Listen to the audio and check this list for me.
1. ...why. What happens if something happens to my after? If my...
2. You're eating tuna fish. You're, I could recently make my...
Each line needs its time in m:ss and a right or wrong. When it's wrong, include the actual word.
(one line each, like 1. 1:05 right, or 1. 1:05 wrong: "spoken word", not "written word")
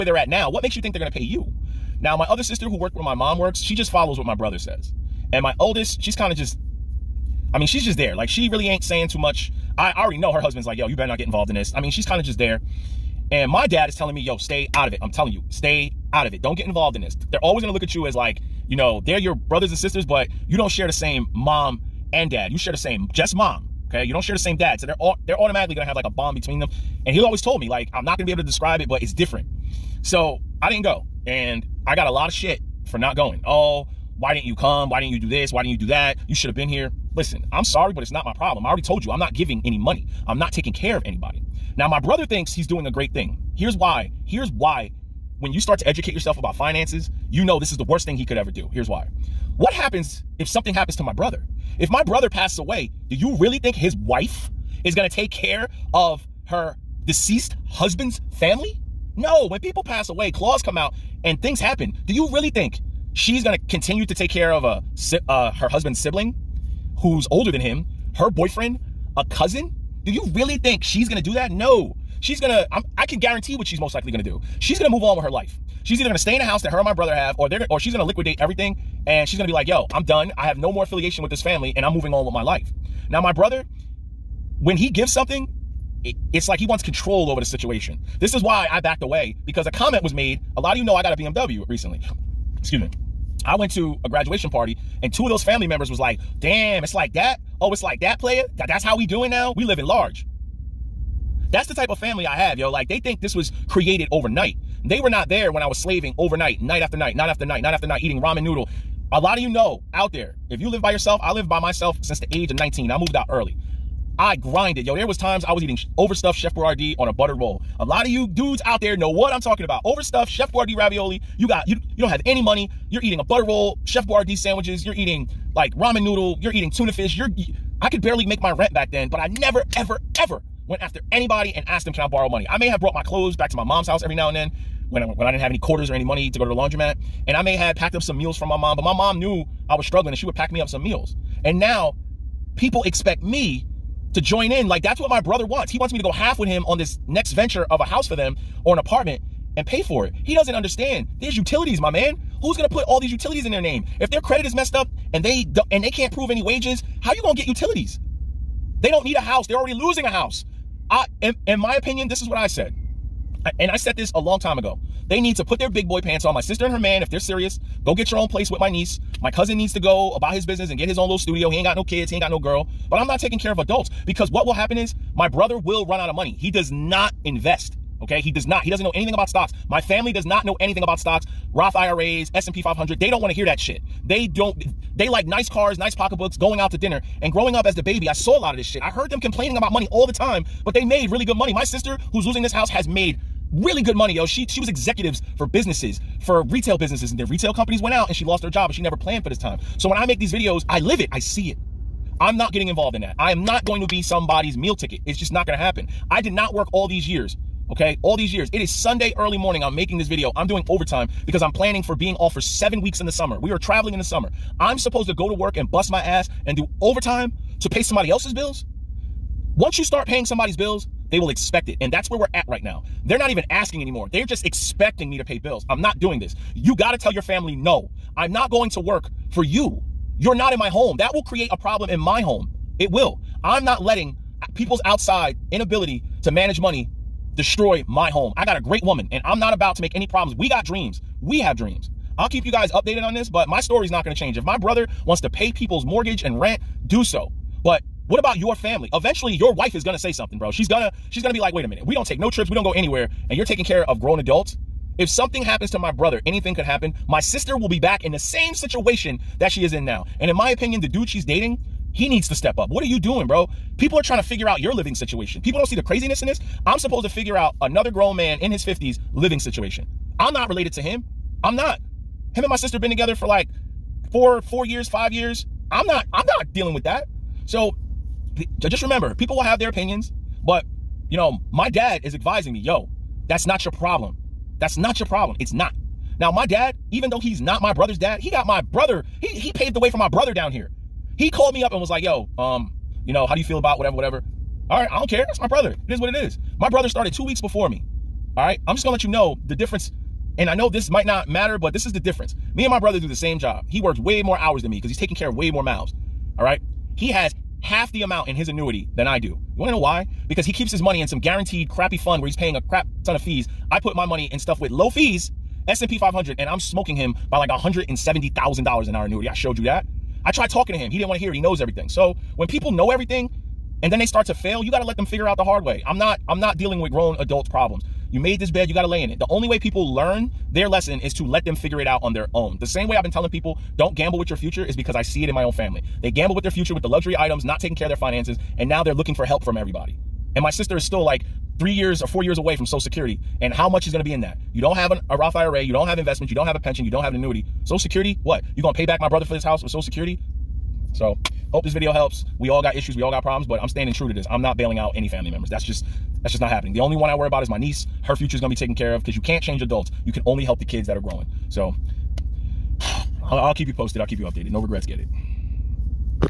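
1. 0:48 wrong: "brother", not "after"
2. 2:06 wrong: "barely", not "recently".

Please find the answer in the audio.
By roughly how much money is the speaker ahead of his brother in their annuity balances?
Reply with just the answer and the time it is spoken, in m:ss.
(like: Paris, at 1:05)
$170,000, at 5:17.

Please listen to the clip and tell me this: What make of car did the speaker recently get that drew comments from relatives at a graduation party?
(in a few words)
BMW.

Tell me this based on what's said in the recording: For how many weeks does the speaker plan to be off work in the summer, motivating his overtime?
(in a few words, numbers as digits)
7.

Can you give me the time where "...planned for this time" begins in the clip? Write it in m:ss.
3:18.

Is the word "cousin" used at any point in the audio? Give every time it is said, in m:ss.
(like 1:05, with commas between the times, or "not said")
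1:09, 2:49.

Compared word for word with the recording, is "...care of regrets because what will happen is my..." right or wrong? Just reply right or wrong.
wrong.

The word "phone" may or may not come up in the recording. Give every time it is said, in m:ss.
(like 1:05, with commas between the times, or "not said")
not said.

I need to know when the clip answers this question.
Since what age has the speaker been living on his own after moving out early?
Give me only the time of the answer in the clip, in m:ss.
1:52.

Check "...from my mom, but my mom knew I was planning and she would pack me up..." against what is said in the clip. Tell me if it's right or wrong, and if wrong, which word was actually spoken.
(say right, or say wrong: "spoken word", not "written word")
wrong: "struggling", not "planning".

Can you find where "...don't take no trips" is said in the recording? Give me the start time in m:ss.
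4:11.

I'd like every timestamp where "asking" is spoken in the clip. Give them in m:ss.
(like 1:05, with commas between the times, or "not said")
3:43.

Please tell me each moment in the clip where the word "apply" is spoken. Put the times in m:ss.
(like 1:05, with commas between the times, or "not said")
not said.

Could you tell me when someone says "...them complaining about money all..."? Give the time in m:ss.
3:09.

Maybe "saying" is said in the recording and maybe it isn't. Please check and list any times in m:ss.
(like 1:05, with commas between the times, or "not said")
0:08.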